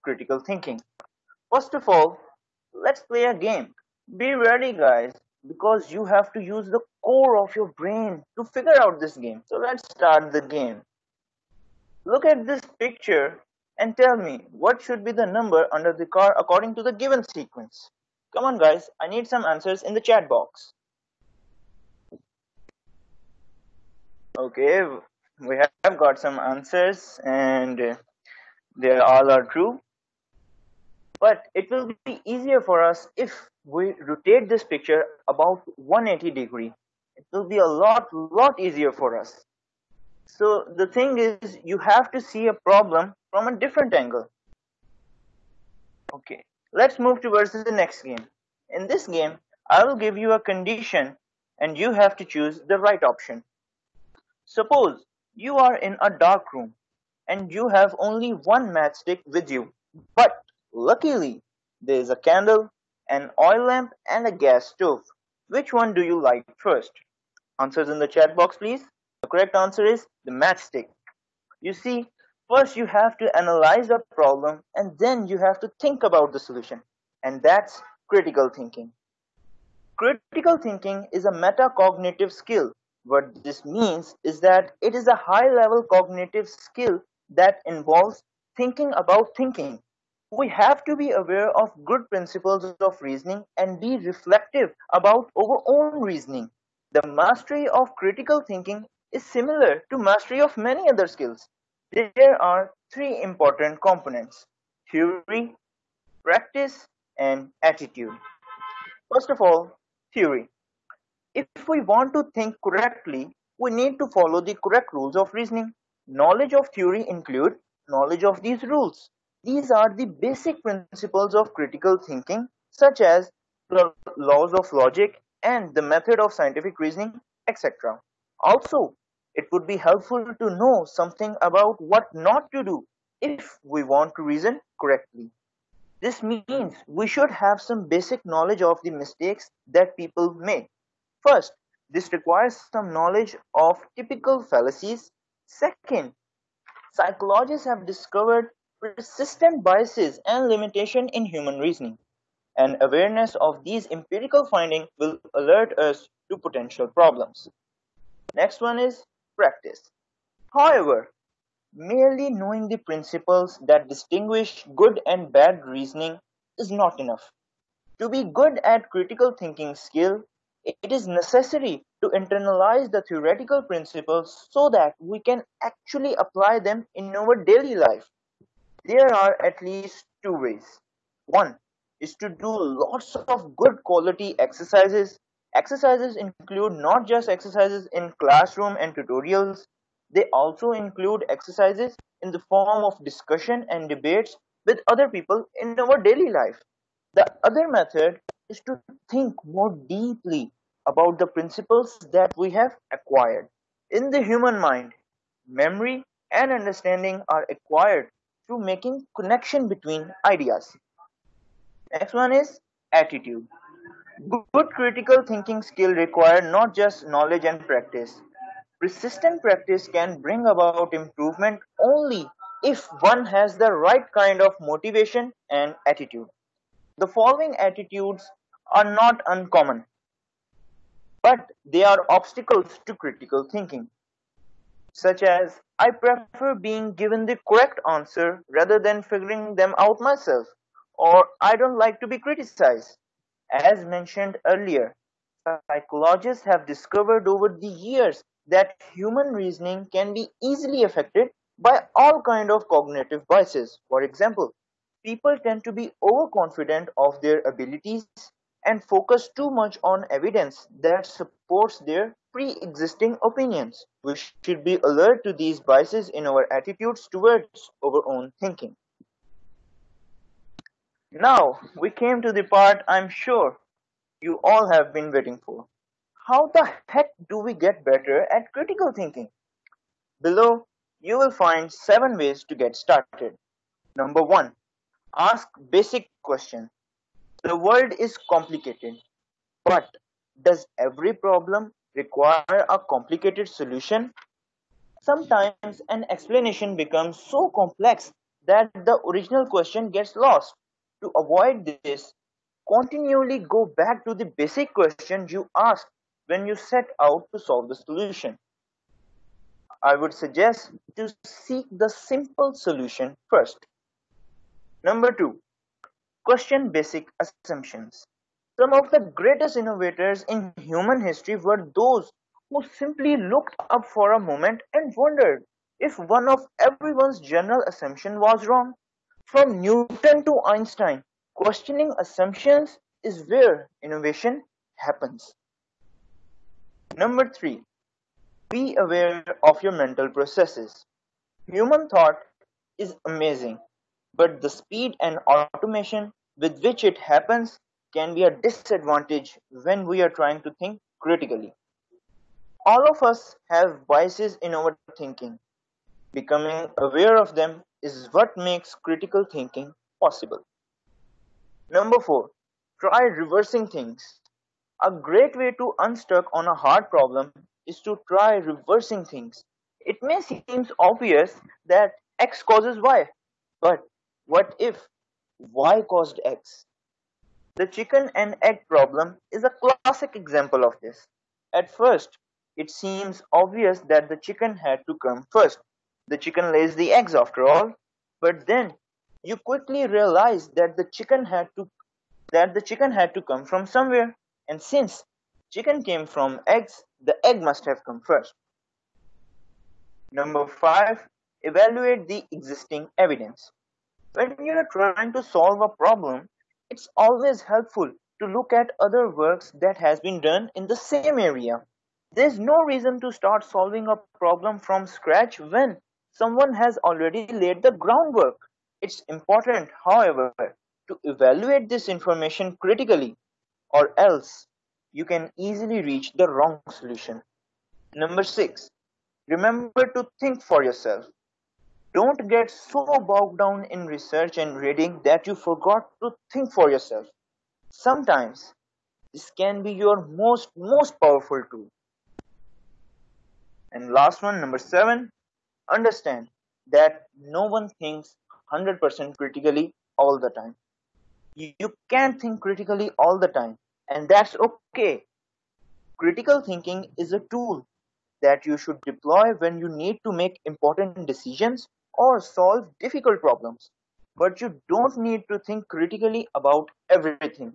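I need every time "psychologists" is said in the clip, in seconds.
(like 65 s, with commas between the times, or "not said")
146 s, 245 s.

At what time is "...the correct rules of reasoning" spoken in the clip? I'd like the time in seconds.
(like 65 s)
114 s.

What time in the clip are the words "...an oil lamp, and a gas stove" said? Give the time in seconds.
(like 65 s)
63 s.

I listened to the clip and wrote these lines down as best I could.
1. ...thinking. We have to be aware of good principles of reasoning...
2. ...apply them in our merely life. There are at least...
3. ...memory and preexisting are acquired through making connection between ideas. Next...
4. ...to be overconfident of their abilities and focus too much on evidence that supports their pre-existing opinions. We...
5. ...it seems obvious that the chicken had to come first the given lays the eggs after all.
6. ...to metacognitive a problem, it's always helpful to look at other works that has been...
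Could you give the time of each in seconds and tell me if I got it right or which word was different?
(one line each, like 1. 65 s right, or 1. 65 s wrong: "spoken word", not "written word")
1. 89 s right
2. 176 s wrong: "daily", not "merely"
3. 205 s wrong: "understanding", not "preexisting"
4. 255 s right
5. 382 s wrong: "chicken", not "given"
6. 405 s wrong: "solve", not "metacognitive".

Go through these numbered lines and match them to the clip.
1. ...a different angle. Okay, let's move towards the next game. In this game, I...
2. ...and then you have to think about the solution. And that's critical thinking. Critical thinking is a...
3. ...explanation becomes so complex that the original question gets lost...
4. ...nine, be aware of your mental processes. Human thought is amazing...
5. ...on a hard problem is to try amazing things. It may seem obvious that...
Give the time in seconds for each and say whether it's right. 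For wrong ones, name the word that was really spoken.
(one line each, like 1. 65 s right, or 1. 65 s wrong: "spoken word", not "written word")
1. 43 s right
2. 74 s right
3. 296 s right
4. 337 s wrong: "three", not "nine"
5. 366 s wrong: "reversing", not "amazing".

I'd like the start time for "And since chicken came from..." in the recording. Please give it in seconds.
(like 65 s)
394 s.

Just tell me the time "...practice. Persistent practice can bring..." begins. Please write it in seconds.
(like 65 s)
217 s.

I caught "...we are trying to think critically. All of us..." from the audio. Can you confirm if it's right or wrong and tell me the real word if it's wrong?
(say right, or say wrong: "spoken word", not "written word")
right.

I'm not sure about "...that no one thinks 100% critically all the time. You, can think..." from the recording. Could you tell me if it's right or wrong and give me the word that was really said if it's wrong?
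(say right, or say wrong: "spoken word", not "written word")
right.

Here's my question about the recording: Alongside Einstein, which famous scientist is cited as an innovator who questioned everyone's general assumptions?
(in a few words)
Newton.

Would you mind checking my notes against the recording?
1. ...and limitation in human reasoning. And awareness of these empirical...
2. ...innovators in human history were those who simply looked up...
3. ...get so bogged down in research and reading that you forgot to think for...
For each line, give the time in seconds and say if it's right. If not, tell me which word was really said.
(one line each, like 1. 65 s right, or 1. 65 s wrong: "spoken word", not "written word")
1. 150 s right
2. 319 s right
3. 432 s right.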